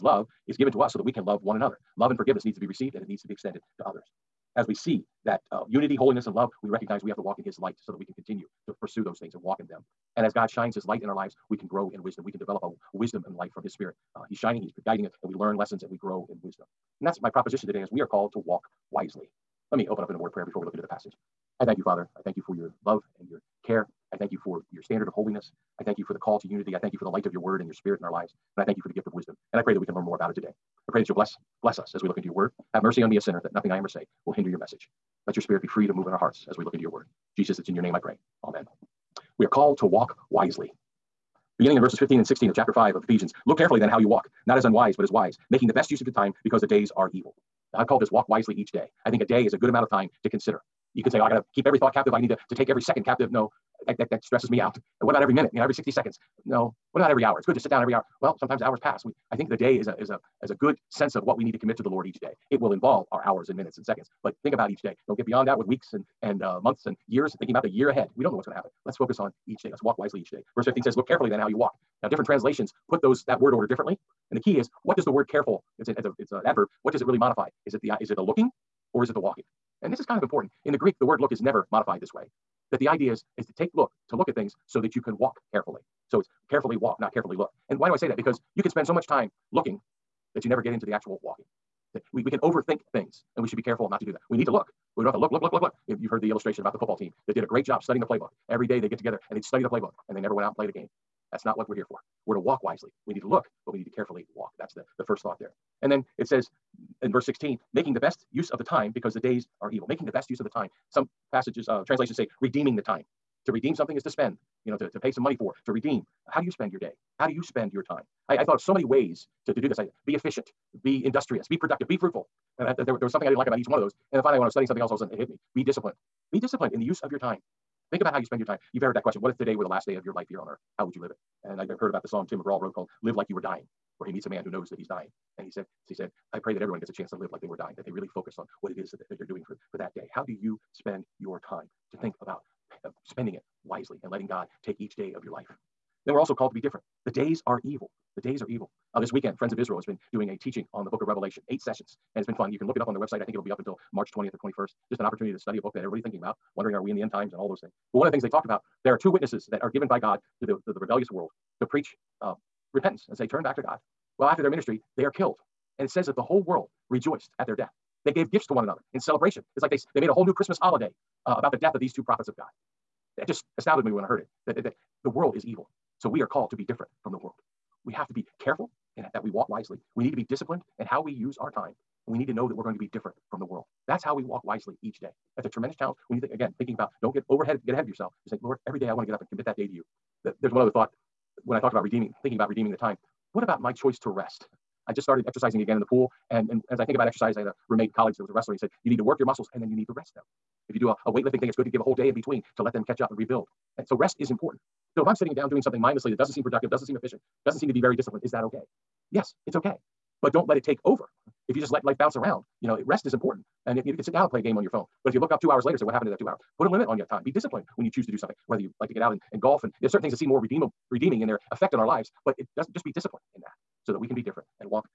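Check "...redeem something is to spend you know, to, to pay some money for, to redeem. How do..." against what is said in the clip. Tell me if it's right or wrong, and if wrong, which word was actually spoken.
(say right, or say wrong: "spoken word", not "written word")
right.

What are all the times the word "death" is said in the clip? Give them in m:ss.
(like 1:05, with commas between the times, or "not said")
2:47, 2:51.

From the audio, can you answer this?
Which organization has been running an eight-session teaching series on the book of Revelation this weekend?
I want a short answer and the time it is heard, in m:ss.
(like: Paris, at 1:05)
Friends of Israel, at 2:29.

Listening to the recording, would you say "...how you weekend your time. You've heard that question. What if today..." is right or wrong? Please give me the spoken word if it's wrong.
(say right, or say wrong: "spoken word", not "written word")
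wrong: "spend", not "weekend".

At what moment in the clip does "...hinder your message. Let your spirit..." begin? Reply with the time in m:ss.
0:34.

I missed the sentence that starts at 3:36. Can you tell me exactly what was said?
Put a limit on your time.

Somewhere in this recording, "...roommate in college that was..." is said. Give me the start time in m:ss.
3:17.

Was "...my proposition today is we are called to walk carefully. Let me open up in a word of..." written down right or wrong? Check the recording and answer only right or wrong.
wrong.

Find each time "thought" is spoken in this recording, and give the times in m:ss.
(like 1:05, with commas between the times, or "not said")
0:51, 1:45, 1:58, 3:10.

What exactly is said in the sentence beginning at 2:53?
It just astounded me when I heard it that, that, that the world is evil.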